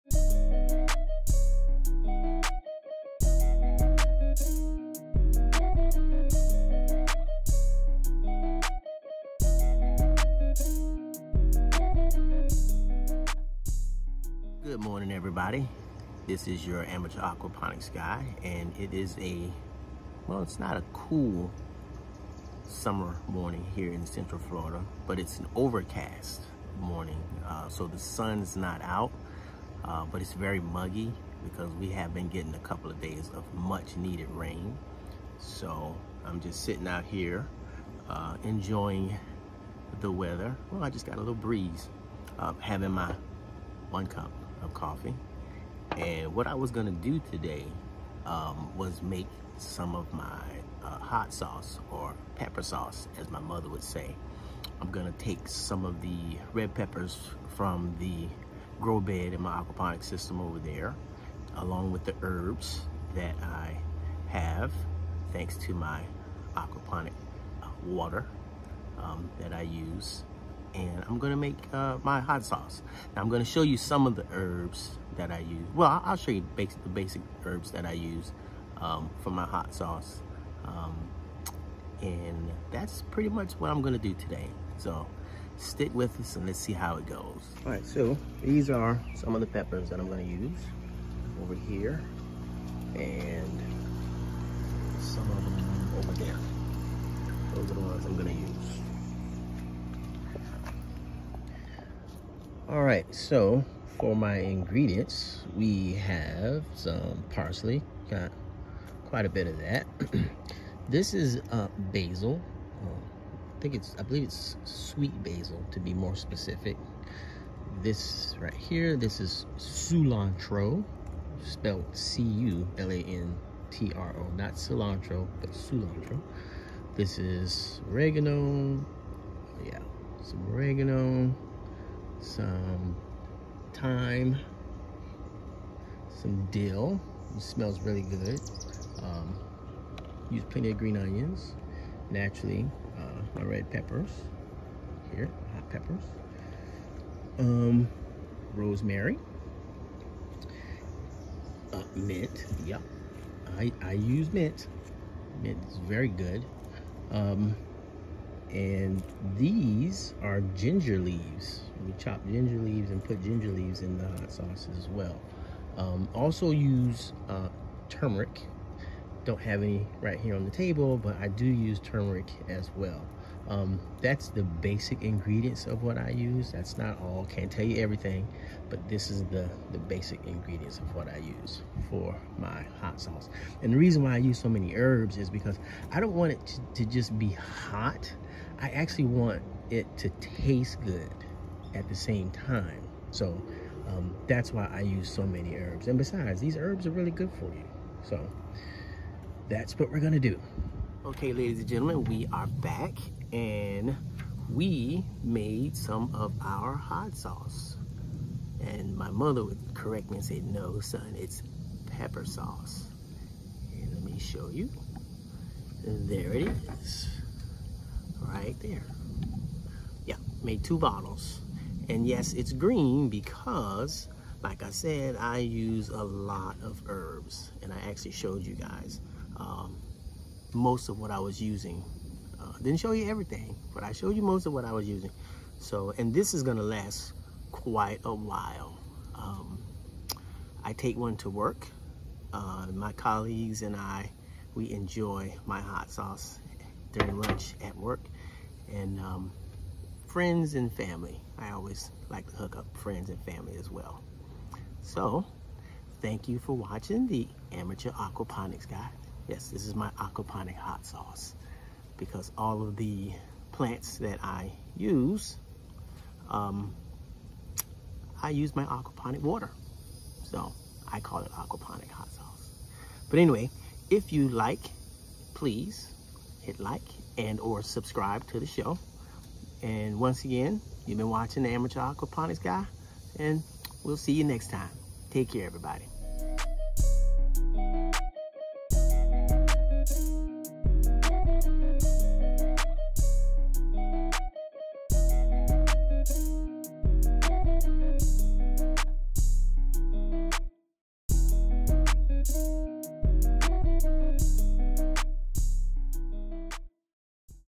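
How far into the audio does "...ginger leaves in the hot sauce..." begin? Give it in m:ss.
2:43.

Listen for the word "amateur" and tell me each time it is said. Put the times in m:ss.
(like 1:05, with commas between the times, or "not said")
0:16, 4:17, 4:41.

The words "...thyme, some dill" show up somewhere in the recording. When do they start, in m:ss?
2:13.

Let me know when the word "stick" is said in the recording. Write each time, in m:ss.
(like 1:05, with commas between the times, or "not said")
1:25.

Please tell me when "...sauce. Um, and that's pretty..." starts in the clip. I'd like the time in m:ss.
1:19.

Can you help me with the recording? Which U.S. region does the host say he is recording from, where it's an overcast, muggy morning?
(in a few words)
Central Florida.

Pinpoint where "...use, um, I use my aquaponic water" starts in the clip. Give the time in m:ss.
4:24.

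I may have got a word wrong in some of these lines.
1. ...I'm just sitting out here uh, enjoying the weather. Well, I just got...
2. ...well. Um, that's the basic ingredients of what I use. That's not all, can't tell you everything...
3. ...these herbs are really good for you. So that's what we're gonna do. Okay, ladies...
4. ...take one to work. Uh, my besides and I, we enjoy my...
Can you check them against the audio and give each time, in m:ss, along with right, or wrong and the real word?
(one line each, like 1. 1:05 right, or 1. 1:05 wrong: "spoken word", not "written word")
1. 0:36 right
2. 2:52 right
3. 3:16 right
4. 4:00 wrong: "colleagues", not "besides".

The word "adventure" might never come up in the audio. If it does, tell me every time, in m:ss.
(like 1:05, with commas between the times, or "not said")
not said.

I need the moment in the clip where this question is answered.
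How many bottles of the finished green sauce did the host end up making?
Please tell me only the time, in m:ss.
3:40.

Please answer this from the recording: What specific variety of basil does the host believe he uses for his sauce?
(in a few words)
Sweet basil.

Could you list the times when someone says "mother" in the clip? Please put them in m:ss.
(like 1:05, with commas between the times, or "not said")
0:53, 3:29.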